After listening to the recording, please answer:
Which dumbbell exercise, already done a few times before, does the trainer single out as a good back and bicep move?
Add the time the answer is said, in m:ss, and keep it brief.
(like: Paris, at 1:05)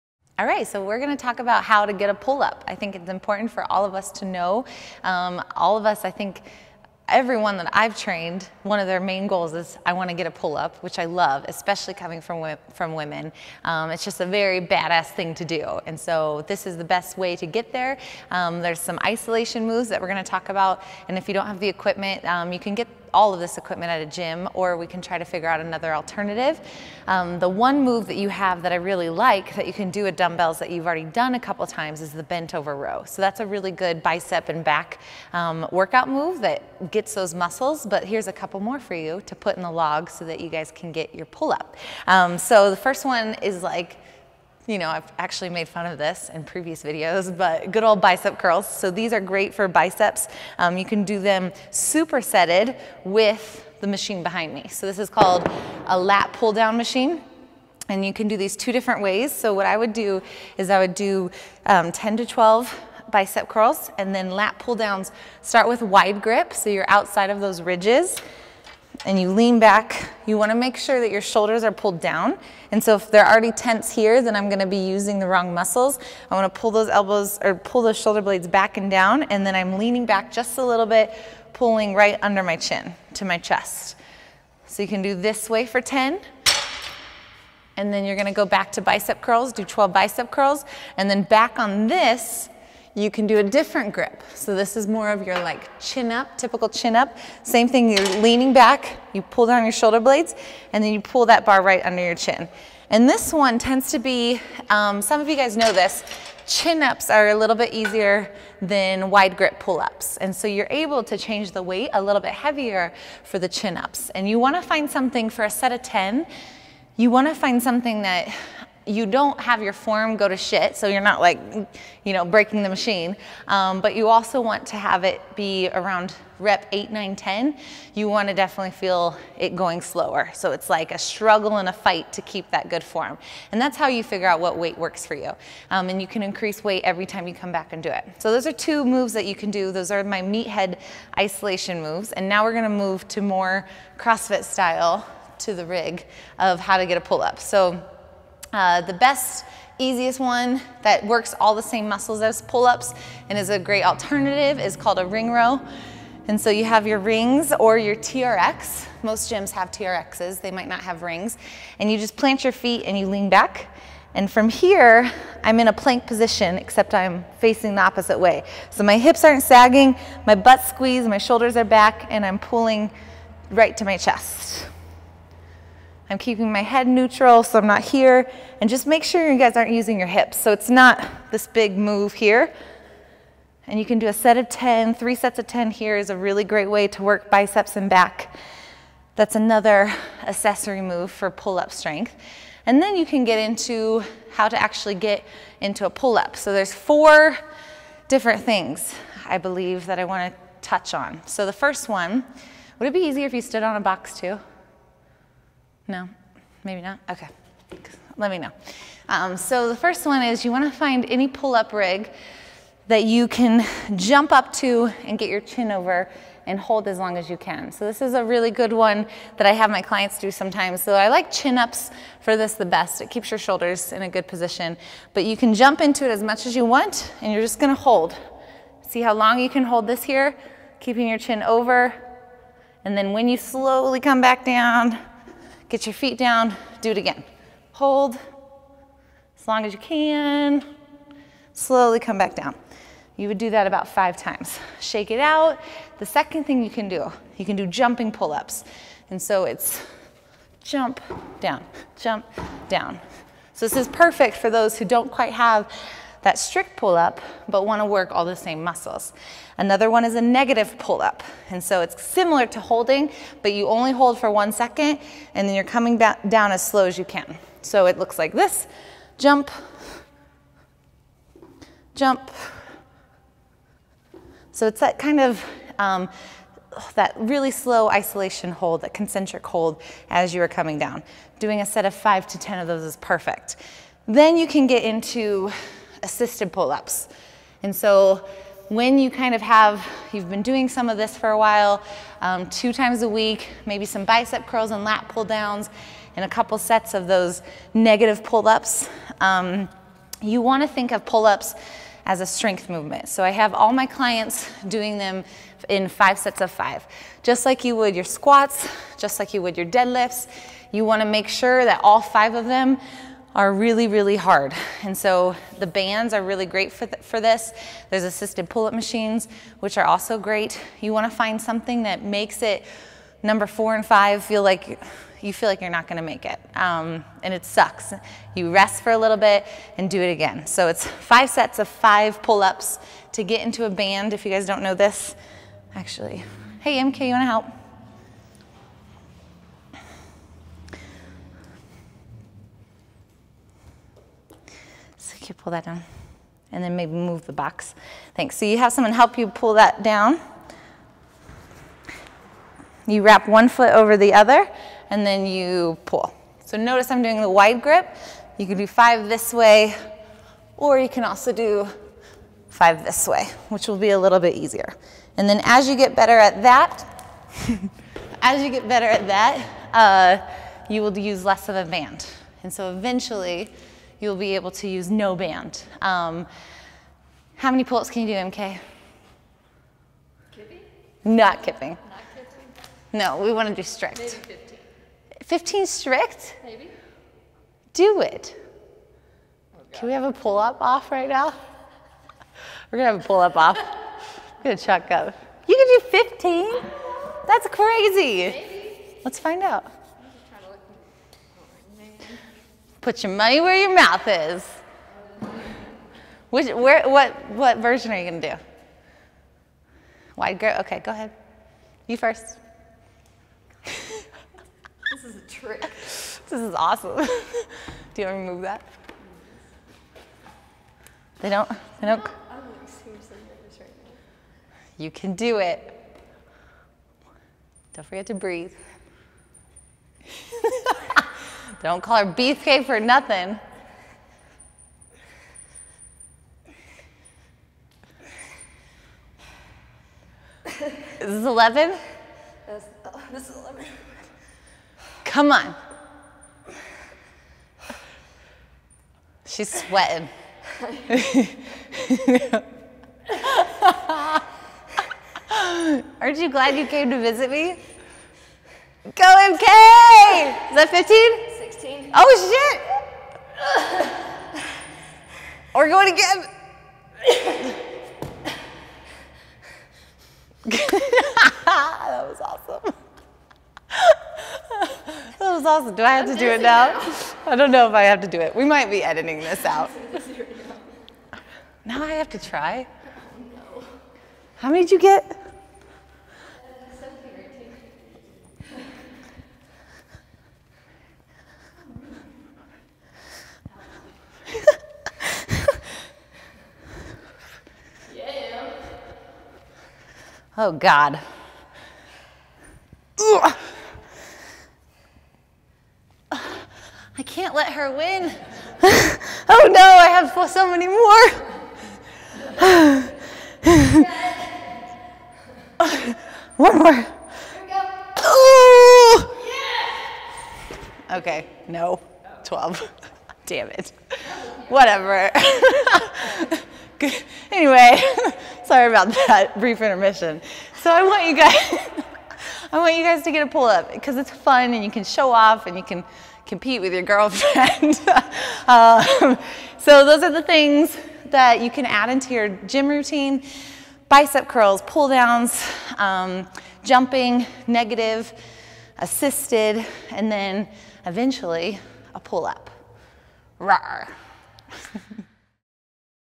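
Bent over row, at 0:32.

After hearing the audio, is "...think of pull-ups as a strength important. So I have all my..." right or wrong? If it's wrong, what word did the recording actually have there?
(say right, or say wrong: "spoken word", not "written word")
wrong: "movement", not "important".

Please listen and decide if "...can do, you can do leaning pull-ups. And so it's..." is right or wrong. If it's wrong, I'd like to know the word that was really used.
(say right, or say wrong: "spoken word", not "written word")
wrong: "jumping", not "leaning".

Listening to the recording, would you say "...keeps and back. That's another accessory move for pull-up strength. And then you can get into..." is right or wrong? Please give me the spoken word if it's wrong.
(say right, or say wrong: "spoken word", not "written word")
wrong: "biceps", not "keeps".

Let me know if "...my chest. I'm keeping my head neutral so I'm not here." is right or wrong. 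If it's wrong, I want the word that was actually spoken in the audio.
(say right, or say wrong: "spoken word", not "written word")
right.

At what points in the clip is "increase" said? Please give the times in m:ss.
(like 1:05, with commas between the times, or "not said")
2:16.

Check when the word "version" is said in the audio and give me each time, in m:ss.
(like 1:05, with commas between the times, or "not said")
6:47.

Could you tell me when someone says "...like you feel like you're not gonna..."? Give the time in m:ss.
5:24.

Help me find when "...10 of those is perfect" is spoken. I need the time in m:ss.
4:42.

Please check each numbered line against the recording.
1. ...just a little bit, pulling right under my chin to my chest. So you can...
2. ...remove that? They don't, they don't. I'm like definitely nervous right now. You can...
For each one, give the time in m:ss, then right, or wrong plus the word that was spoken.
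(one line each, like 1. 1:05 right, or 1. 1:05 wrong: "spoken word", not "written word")
1. 1:20 right
2. 6:58 wrong: "seriously", not "definitely".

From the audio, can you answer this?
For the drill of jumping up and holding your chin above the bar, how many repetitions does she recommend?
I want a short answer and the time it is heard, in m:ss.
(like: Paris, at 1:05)
About five times, at 4:03.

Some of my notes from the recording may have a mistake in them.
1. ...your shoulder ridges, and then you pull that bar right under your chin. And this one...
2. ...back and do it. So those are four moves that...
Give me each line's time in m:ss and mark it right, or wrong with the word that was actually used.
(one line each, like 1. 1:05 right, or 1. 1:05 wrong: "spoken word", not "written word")
1. 1:39 wrong: "blades", not "ridges"
2. 2:17 wrong: "two", not "four".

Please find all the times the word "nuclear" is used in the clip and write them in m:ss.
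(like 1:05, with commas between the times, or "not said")
not said.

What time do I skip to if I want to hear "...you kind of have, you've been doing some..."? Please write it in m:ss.
4:48.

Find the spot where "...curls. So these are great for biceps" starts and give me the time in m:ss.
0:48.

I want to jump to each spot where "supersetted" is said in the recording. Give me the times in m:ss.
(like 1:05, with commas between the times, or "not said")
0:51.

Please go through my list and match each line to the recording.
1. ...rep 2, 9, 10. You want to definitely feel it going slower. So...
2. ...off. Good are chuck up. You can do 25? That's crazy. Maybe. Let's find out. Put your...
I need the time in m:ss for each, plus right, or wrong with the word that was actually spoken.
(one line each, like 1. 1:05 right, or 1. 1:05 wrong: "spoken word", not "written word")
1. 2:06 wrong: "8", not "2"
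2. 6:33 wrong: "15", not "25".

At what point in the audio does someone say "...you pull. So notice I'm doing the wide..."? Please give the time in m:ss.
5:55.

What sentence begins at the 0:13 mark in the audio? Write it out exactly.
Um, it's just a very badass thing to do, and so this is the best way to get there.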